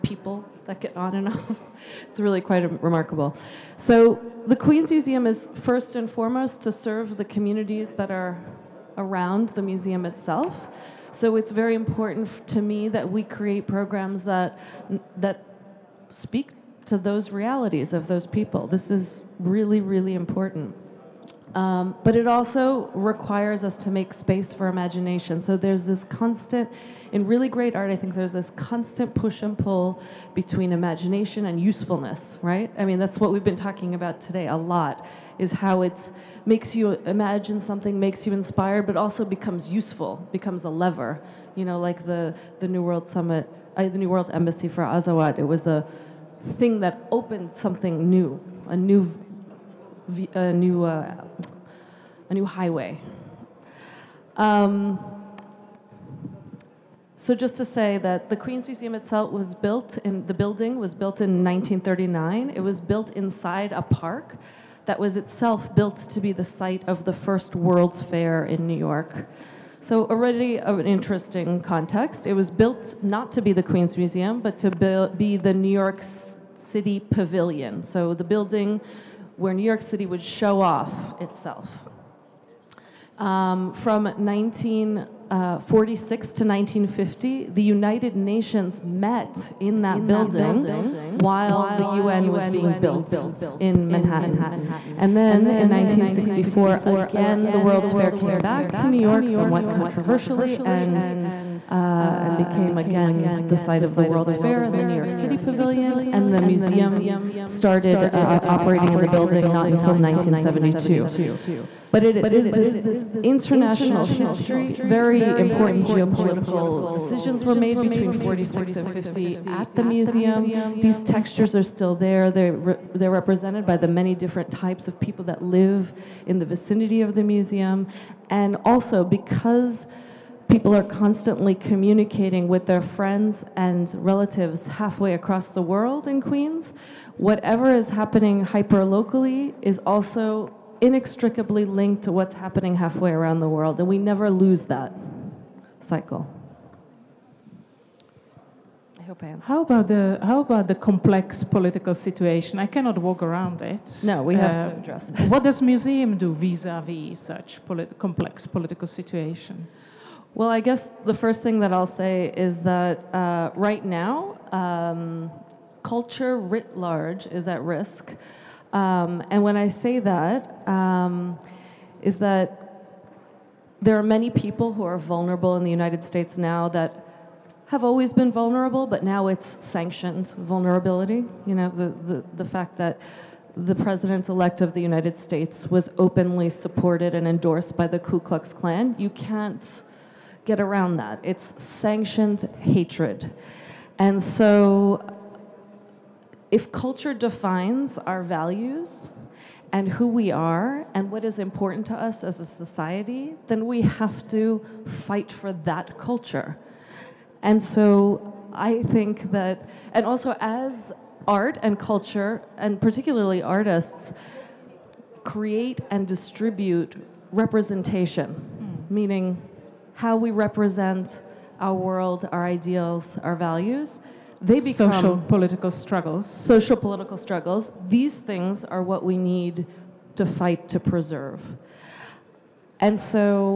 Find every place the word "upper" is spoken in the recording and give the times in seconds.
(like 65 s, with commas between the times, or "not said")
not said.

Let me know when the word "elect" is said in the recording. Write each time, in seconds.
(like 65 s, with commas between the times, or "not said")
184 s.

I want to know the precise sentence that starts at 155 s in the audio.
What does museum do vis-a-vis -vis such polit complex political situation?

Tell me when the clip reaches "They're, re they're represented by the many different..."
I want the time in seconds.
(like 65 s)
122 s.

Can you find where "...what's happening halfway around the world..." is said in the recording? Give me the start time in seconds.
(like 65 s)
142 s.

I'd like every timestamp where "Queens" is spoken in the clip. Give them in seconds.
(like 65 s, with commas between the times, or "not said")
4 s, 58 s, 73 s, 136 s.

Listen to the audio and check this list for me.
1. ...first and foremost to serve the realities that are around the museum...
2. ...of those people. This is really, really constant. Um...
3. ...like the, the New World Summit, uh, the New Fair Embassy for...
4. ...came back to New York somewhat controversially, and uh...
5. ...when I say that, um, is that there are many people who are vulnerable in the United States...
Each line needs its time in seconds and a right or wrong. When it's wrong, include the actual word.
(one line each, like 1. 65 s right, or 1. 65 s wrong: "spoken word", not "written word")
1. 5 s wrong: "communities", not "realities"
2. 17 s wrong: "important", not "constant"
3. 41 s wrong: "World", not "Fair"
4. 98 s right
5. 169 s right.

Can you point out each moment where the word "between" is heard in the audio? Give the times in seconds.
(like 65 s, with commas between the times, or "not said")
30 s, 117 s.